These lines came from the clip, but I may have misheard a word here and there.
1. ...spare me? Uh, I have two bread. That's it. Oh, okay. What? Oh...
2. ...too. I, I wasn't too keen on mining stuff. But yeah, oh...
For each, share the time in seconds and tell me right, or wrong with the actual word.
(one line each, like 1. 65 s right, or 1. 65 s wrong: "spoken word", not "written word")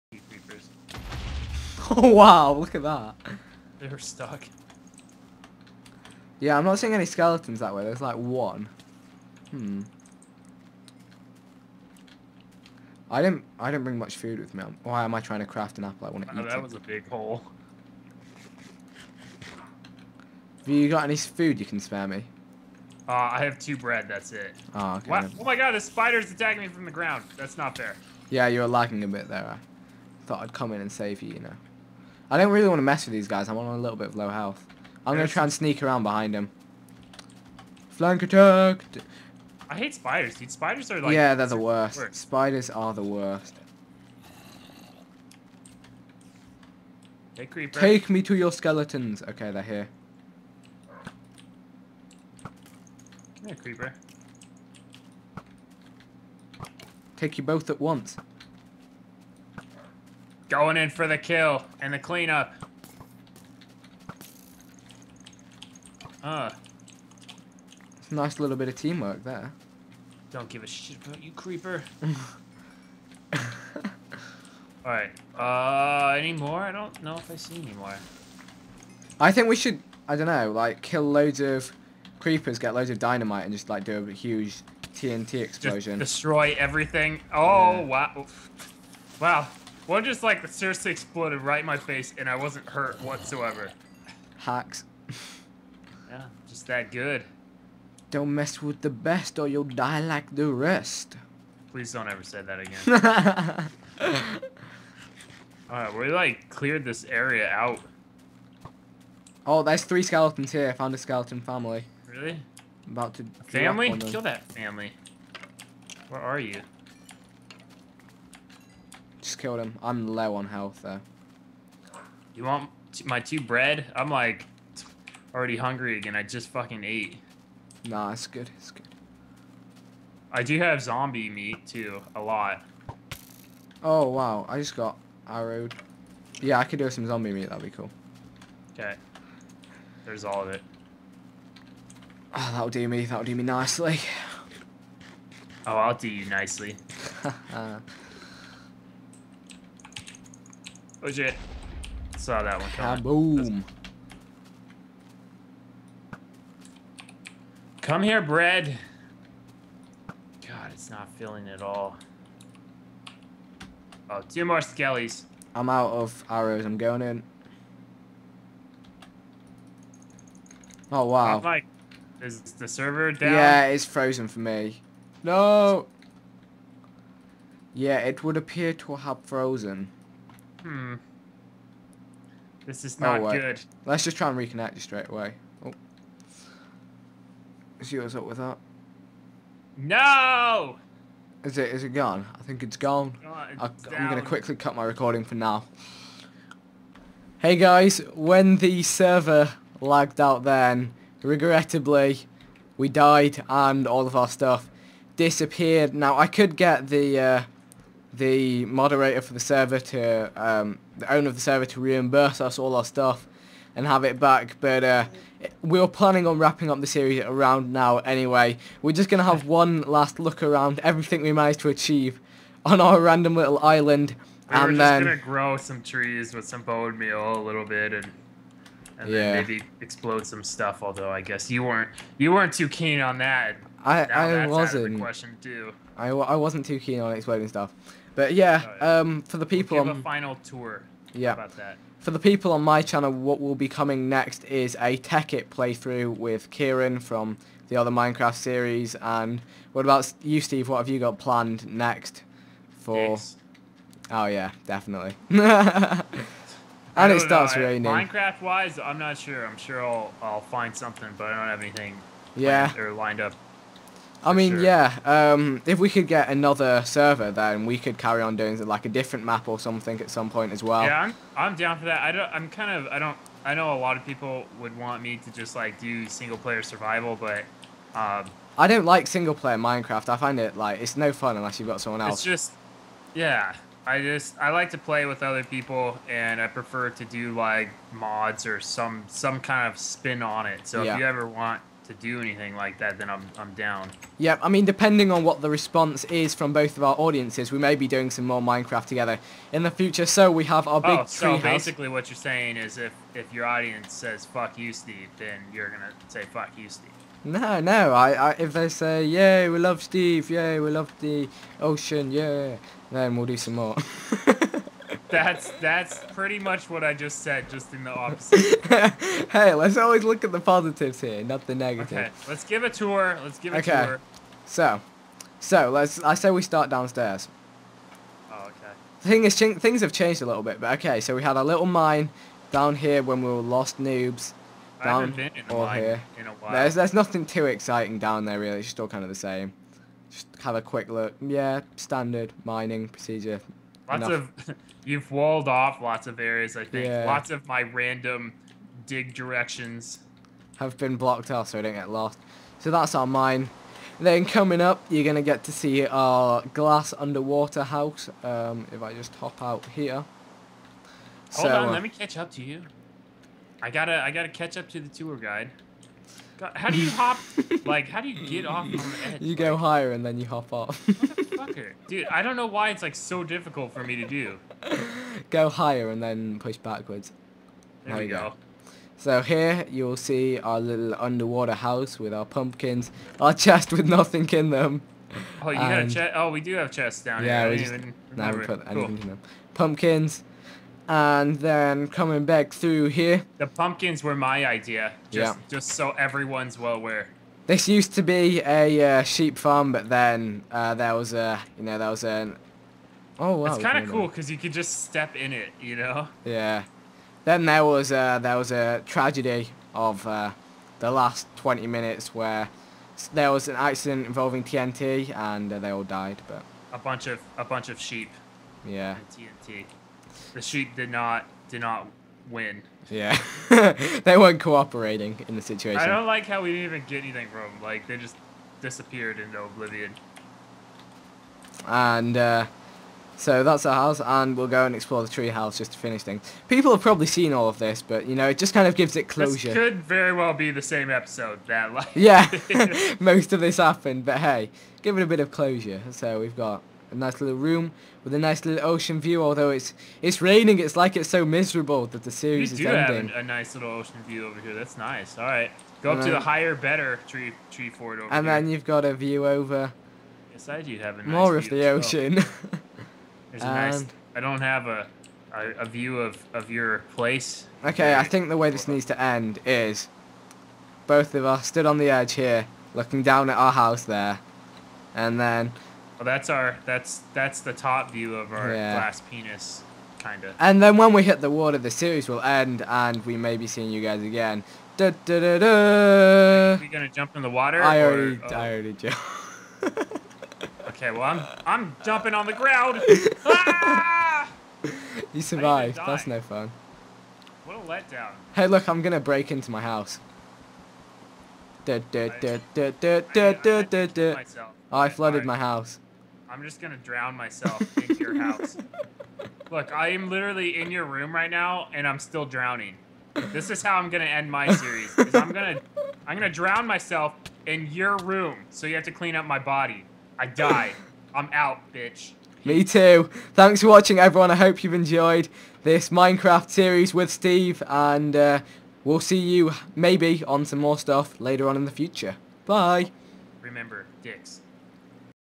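1. 21 s right
2. 235 s wrong: "exploding", not "mining".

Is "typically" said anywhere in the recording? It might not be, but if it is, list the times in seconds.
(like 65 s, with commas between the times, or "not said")
not said.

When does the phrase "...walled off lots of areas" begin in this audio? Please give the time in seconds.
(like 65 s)
345 s.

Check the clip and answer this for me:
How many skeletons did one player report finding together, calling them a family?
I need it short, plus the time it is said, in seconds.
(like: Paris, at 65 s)
3, at 109 s.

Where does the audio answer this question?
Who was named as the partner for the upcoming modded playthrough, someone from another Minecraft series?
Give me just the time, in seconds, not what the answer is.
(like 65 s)
246 s.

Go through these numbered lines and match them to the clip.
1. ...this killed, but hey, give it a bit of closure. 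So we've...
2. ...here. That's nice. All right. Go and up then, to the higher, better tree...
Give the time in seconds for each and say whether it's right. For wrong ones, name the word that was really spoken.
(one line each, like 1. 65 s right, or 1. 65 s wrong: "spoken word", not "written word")
1. 443 s wrong: "happened", not "killed"
2. 454 s right.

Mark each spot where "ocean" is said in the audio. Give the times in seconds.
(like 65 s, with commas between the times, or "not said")
311 s, 448 s, 453 s, 461 s.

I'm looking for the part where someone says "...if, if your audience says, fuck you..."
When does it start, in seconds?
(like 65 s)
302 s.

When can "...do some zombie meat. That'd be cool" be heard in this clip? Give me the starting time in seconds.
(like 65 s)
136 s.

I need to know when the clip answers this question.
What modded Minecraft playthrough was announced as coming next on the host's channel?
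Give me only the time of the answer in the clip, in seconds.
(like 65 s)
244 s.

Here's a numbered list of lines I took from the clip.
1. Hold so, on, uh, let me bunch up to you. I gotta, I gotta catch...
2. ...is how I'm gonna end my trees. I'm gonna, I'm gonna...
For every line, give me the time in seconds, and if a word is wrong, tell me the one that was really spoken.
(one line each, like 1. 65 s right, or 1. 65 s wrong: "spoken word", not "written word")
1. 361 s wrong: "catch", not "bunch"
2. 513 s wrong: "series", not "trees".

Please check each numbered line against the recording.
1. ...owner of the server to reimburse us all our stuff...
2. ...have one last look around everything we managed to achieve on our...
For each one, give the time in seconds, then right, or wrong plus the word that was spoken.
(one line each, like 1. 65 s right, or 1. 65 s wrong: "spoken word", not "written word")
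1. 211 s right
2. 219 s right.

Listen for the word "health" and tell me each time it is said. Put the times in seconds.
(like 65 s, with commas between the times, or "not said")
34 s, 120 s.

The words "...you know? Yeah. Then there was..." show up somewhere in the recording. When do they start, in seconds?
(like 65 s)
405 s.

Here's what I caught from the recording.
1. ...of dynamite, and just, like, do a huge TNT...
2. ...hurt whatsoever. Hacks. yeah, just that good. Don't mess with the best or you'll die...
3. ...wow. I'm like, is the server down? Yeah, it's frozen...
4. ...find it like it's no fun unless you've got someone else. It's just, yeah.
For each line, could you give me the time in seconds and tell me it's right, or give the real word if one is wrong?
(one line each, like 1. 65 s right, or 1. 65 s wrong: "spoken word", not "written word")
1. 82 s right
2. 92 s right
3. 171 s right
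4. 280 s right.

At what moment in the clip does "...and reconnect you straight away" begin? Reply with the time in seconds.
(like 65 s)
184 s.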